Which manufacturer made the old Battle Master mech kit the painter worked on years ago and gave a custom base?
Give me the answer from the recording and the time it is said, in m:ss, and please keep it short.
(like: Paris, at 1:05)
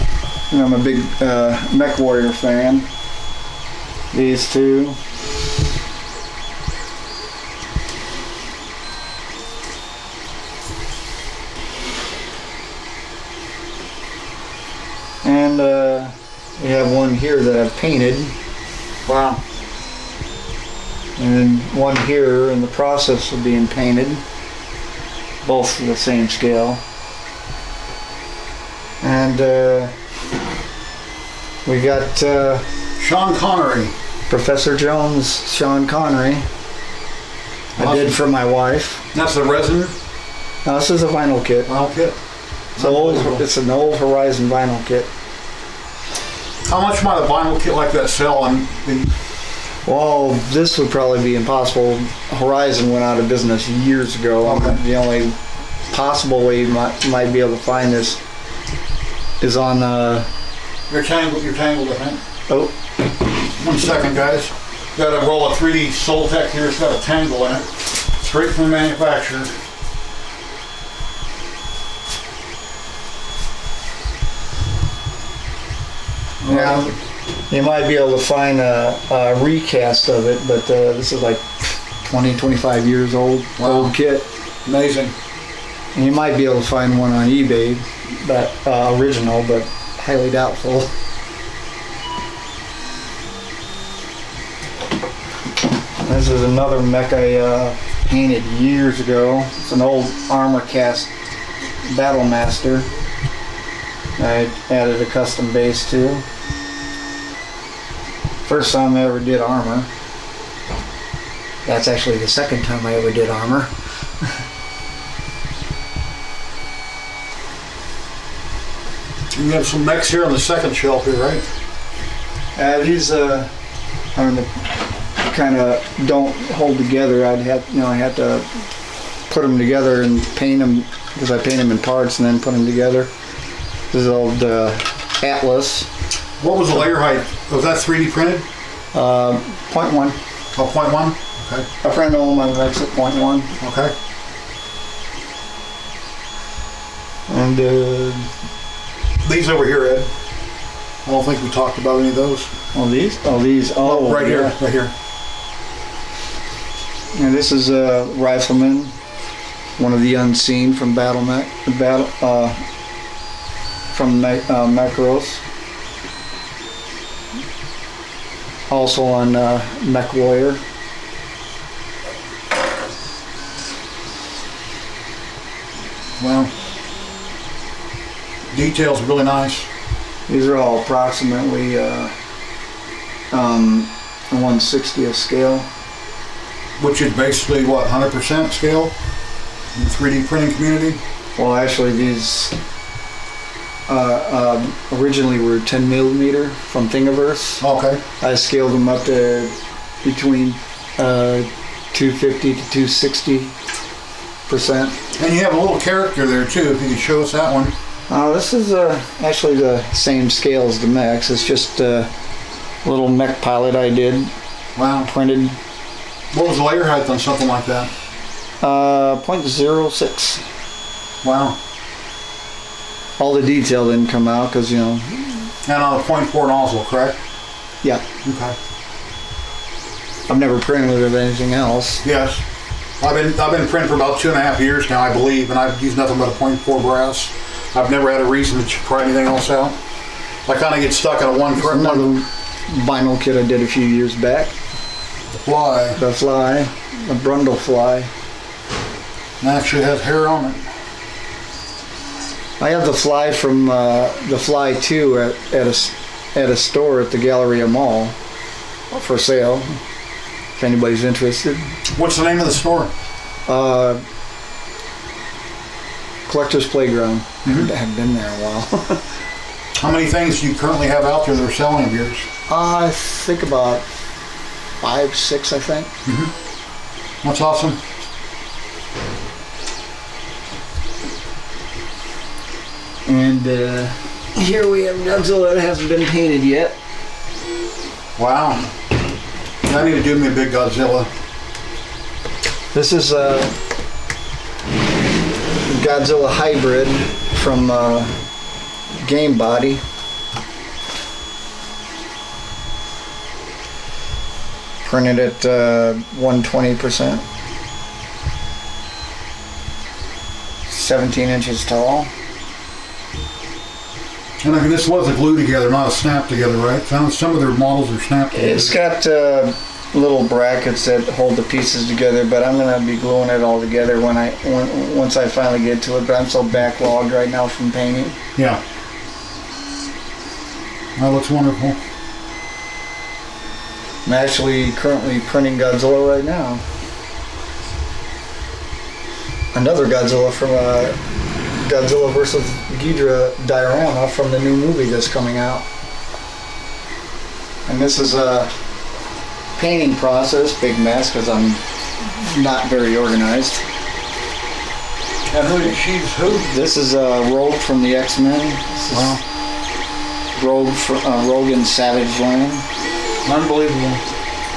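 Armor Cast, at 1:40.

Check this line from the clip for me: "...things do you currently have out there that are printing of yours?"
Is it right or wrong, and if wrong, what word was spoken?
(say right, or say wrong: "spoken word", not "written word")
wrong: "selling", not "printing".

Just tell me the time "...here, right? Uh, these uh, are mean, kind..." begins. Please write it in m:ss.
2:01.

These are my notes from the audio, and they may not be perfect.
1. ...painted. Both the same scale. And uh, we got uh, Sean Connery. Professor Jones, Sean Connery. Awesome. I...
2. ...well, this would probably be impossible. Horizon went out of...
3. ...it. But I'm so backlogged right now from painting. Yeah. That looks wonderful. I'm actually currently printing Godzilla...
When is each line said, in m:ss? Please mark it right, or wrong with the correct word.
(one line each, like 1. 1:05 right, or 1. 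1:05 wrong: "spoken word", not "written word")
1. 0:23 right
2. 0:49 right
3. 5:25 right.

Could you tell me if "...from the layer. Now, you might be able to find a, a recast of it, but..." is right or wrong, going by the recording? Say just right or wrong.
wrong.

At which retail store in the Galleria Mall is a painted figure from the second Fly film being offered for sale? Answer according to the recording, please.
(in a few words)
Collector's Playground.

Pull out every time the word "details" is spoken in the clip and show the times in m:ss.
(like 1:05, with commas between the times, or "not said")
2:58, 3:43.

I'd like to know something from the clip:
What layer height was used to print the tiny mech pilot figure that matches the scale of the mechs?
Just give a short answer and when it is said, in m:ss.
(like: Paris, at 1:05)
0.06, at 3:39.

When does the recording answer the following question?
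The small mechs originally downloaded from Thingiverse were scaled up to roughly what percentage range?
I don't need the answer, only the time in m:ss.
3:21.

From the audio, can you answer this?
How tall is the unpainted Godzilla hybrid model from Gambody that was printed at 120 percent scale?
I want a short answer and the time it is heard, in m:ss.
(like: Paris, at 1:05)
17 inches, at 5:10.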